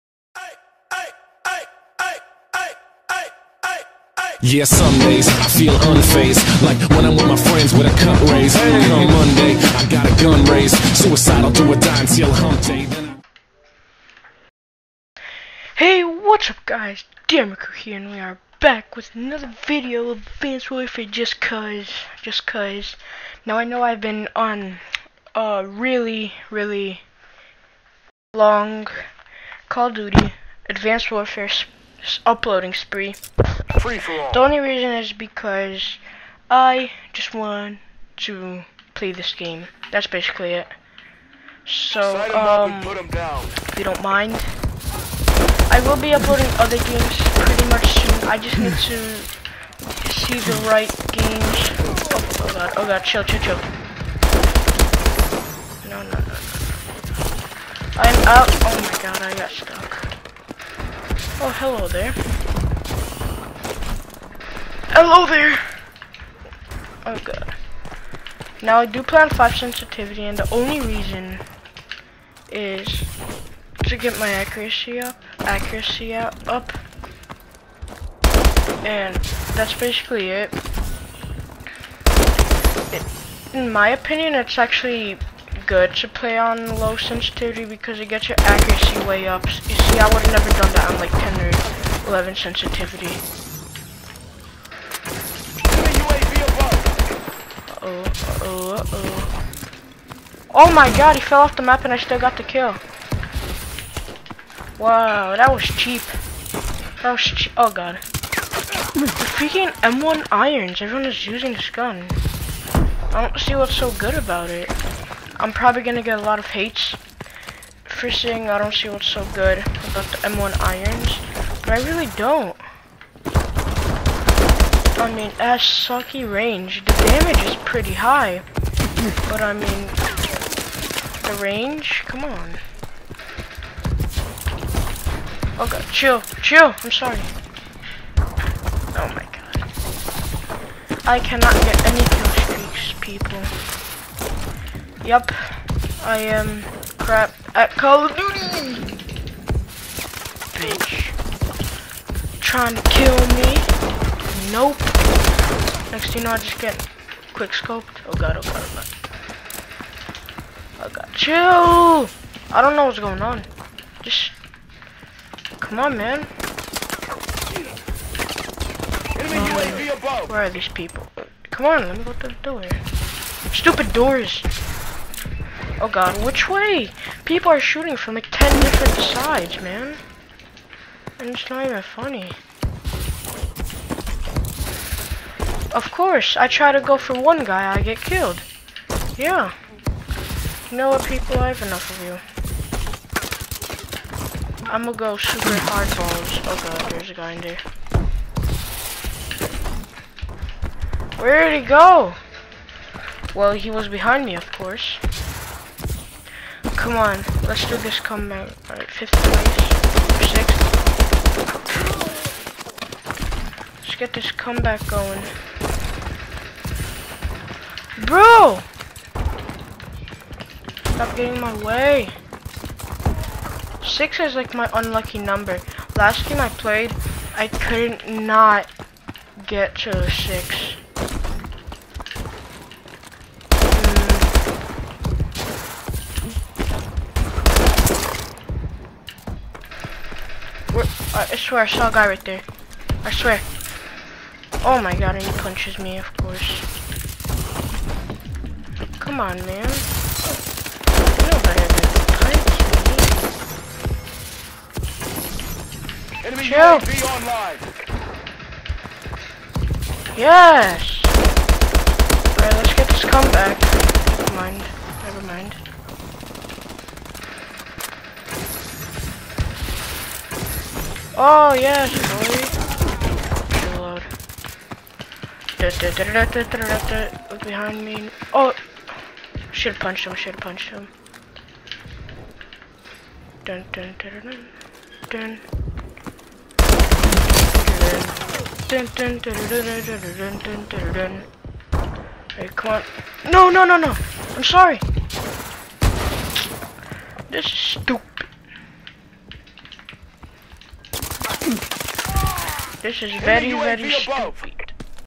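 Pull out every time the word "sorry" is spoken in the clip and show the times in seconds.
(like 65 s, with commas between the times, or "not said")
136 s, 294 s.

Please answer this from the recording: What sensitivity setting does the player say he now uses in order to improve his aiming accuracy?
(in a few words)
5.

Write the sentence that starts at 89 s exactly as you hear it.
You see, I would have never done that on like 10 or 11 sensitivity.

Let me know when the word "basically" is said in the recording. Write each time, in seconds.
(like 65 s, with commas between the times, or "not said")
40 s, 79 s.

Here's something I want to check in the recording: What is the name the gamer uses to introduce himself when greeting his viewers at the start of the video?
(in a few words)
Demico.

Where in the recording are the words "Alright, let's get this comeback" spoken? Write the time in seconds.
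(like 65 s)
261 s.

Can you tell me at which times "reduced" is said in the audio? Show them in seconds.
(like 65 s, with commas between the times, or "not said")
not said.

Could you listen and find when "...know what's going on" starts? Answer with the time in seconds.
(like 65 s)
162 s.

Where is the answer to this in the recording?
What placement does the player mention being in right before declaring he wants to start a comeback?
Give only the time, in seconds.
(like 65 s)
208 s.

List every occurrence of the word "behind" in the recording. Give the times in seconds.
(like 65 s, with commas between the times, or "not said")
203 s, 277 s.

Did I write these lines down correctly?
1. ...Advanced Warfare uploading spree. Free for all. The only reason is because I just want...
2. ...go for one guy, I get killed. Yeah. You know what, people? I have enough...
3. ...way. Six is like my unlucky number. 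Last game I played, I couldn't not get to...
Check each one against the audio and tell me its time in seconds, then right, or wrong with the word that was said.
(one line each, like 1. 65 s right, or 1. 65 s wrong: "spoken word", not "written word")
1. 30 s right
2. 186 s right
3. 221 s right.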